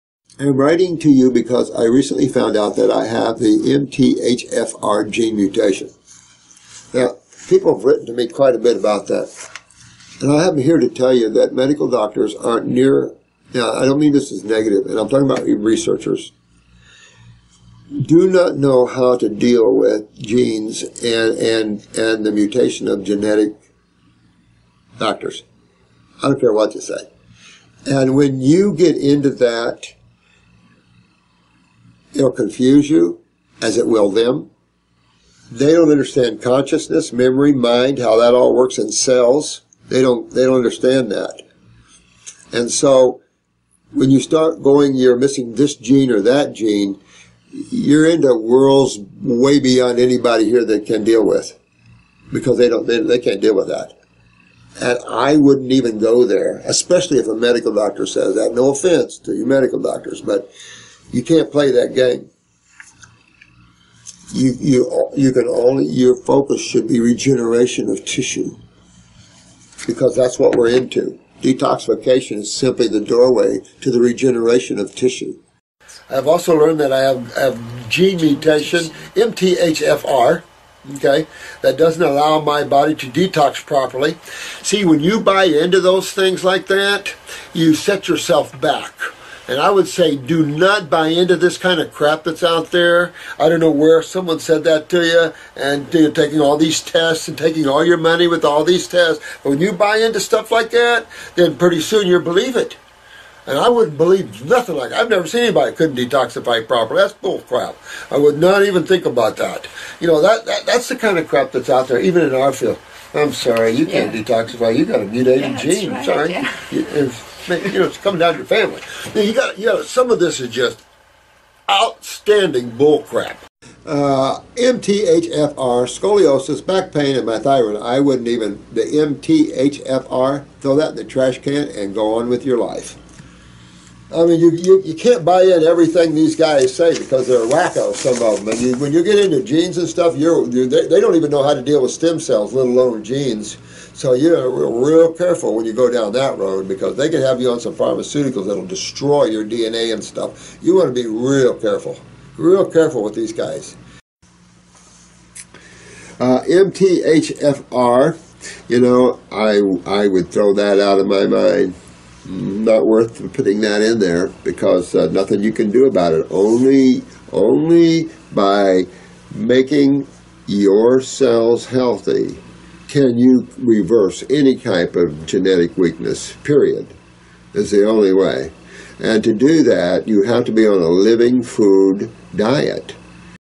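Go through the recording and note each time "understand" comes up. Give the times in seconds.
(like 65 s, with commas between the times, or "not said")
35 s, 40 s.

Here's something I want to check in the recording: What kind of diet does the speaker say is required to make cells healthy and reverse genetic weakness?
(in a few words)
Living food diet.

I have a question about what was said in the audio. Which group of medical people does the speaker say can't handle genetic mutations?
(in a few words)
Researchers.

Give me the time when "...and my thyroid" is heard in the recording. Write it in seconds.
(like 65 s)
127 s.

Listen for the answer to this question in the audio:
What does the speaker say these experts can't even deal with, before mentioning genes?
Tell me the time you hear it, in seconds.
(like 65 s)
141 s.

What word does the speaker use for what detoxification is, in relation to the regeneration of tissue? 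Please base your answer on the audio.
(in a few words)
Doorway.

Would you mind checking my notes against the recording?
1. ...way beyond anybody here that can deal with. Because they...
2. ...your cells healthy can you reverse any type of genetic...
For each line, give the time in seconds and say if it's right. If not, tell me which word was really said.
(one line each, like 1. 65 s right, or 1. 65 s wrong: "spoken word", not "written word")
1. 49 s right
2. 170 s right.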